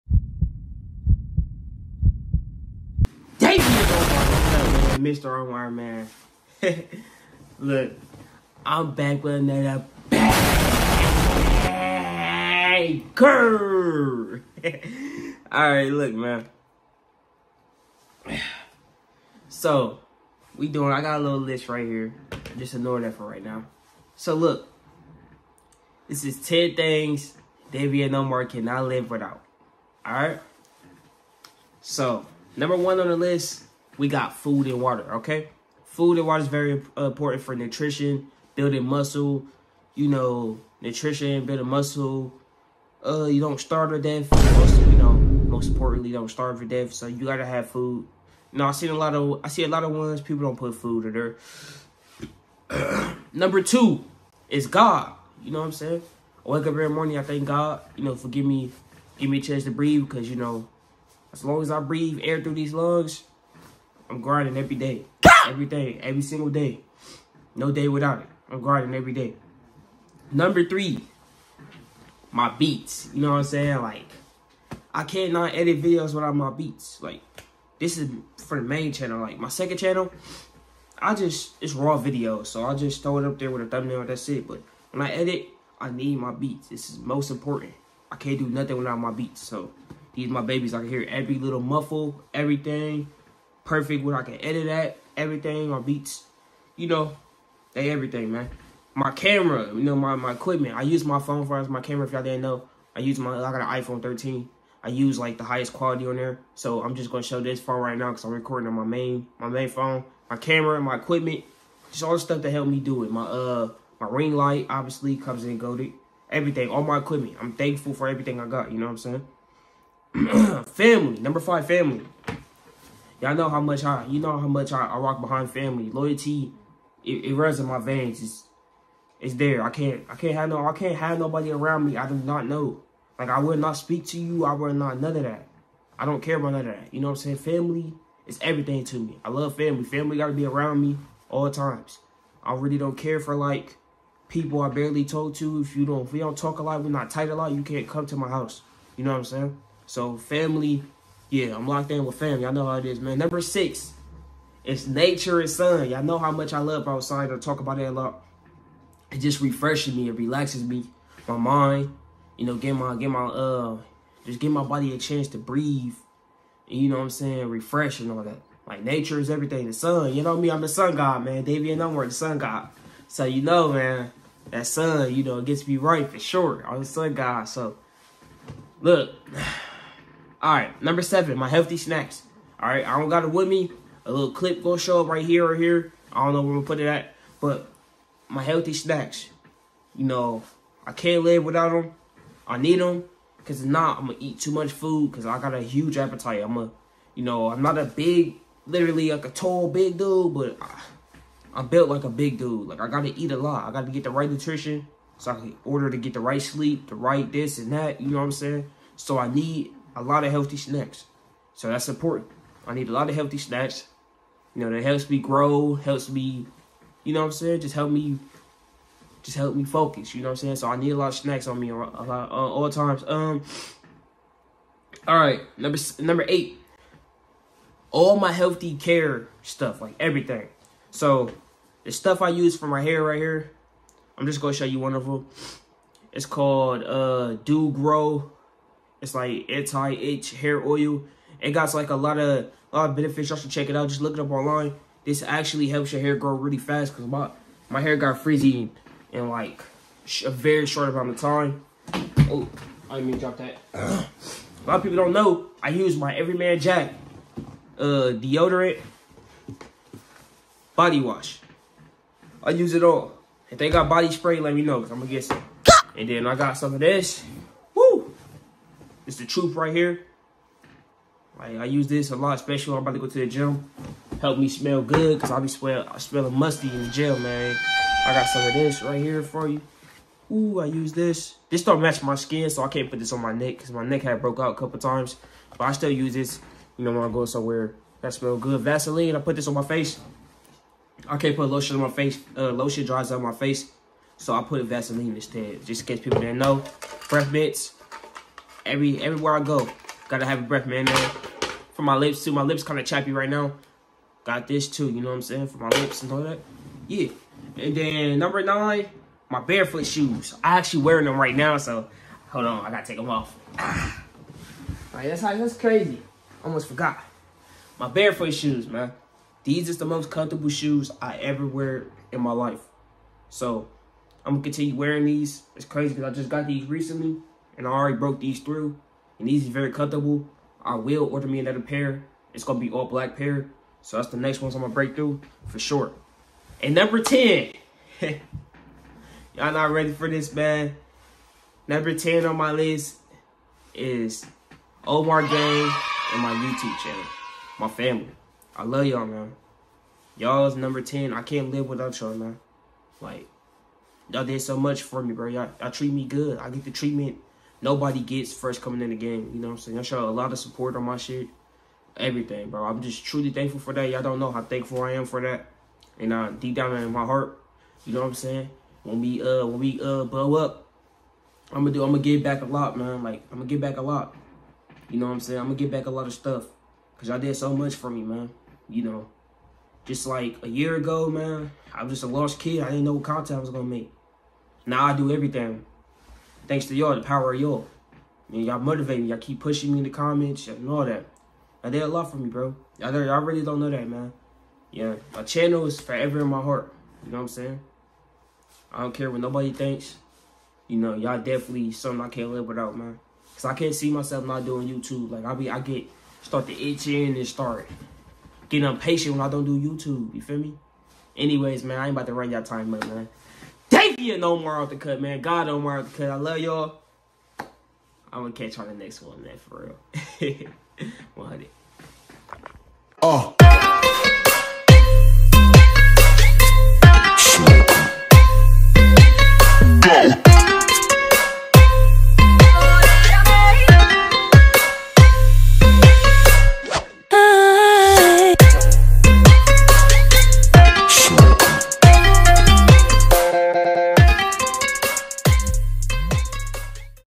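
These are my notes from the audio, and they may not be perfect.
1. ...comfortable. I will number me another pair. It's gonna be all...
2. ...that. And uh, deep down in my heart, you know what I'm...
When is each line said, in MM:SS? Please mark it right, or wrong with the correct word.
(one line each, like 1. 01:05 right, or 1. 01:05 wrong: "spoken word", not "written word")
1. 05:29 wrong: "order", not "number"
2. 06:05 right.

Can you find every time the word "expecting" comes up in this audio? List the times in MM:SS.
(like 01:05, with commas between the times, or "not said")
not said.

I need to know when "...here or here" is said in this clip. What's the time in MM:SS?
03:05.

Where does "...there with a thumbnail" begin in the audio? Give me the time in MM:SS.
01:23.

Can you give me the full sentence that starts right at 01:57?
I'm thankful for everything I got, you know what I'm saying?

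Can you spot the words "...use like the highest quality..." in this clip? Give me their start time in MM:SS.
01:44.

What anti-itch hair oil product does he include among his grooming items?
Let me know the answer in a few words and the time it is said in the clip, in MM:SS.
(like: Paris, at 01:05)
Doo Gro, at 03:57.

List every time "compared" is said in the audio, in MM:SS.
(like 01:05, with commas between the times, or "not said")
not said.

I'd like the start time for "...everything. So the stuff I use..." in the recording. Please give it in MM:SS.
03:49.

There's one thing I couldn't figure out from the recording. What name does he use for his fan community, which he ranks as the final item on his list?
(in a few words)
Omar Gang.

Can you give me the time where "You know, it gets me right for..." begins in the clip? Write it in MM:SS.
02:55.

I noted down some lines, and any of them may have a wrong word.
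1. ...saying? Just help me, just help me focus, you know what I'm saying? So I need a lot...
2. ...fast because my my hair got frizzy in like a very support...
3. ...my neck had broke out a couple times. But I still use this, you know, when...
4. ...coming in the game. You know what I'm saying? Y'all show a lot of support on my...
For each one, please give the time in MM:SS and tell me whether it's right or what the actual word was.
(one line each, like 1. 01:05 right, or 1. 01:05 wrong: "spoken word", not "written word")
1. 03:37 right
2. 04:06 wrong: "short", not "support"
3. 04:43 right
4. 05:58 right.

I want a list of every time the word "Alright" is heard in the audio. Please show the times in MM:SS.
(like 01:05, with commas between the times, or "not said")
00:15, 00:30.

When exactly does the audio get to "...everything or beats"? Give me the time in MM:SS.
01:35.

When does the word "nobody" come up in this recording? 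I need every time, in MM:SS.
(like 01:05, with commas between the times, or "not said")
02:11, 05:57, 06:39.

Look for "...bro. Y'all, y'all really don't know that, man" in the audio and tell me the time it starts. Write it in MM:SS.
06:32.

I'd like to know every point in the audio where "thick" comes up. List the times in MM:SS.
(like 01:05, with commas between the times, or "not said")
not said.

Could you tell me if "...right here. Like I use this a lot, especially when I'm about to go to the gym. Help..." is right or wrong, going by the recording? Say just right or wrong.
right.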